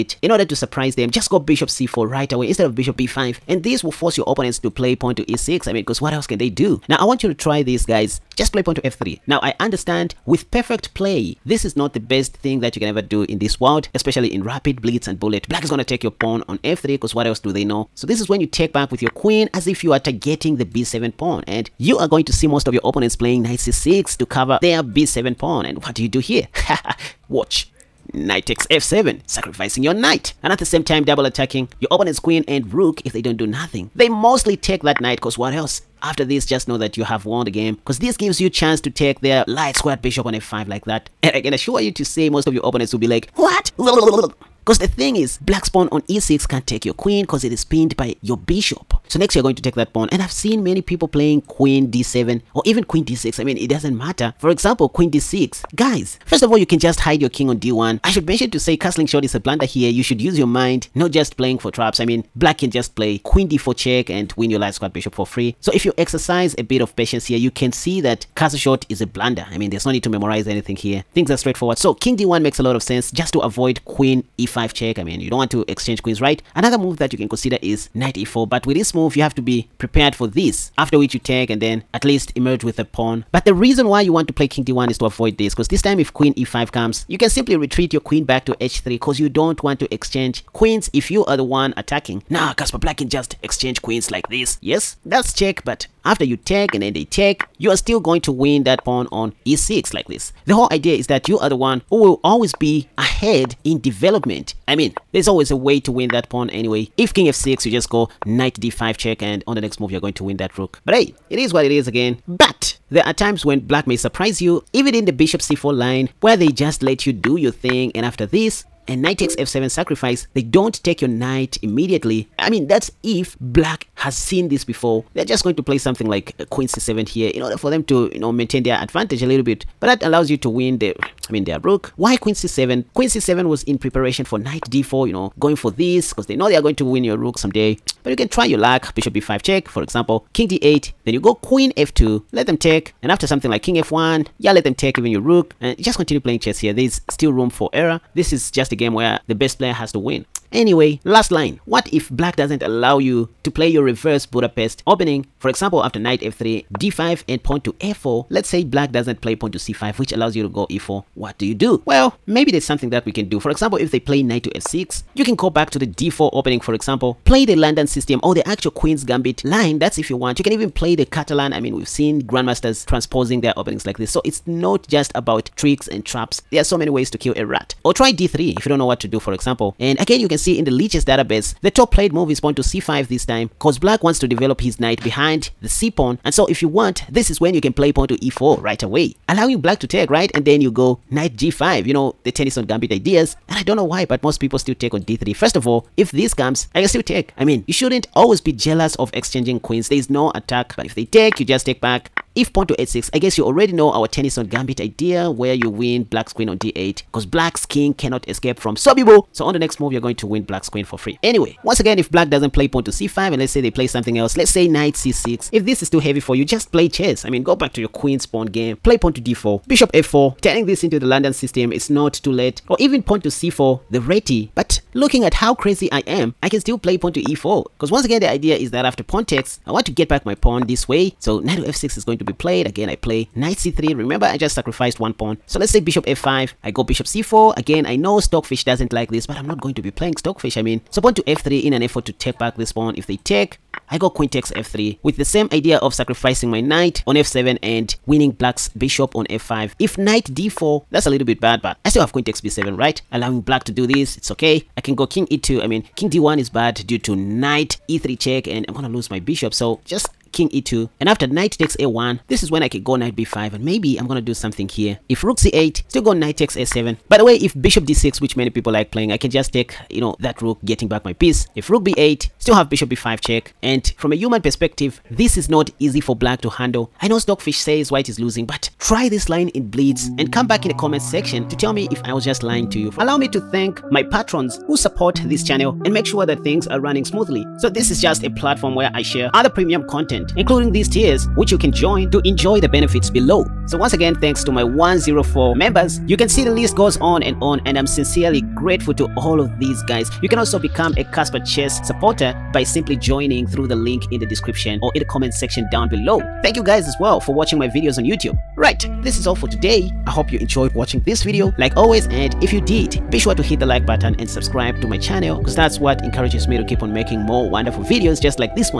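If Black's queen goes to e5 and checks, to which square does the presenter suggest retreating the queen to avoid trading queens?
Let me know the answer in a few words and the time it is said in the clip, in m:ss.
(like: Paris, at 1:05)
h3, at 1:28.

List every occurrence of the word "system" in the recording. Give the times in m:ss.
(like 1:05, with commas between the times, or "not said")
2:47, 3:41.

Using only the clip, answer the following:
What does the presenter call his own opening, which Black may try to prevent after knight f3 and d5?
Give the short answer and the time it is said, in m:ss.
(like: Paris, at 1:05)
Reverse Budapest, at 2:33.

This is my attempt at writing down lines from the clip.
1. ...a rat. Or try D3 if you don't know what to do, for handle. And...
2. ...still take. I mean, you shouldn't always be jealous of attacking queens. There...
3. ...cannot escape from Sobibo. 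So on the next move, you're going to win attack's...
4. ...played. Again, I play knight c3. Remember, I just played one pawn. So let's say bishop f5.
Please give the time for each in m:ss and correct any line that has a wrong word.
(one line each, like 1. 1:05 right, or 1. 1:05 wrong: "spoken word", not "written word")
1. 2:57 wrong: "example", not "handle"
2. 3:16 wrong: "exchanging", not "attacking"
3. 3:27 wrong: "black", not "attack"
4. 3:52 wrong: "sacrificed", not "played".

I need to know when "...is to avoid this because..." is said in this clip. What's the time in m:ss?
1:24.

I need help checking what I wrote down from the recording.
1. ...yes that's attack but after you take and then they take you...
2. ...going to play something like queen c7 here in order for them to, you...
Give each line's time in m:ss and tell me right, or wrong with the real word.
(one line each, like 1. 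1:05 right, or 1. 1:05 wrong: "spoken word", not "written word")
1. 1:34 wrong: "check", not "attack"
2. 2:05 right.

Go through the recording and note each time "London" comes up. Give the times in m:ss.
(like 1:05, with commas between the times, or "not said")
2:47, 3:41.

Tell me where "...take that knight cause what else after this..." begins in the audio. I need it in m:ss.
0:34.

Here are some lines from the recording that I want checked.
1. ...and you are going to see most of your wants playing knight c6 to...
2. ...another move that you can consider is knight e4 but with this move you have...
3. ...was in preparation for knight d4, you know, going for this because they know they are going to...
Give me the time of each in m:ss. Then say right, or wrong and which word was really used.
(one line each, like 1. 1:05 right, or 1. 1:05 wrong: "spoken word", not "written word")
1. 0:21 wrong: "opponents", not "wants"
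2. 1:16 right
3. 2:13 right.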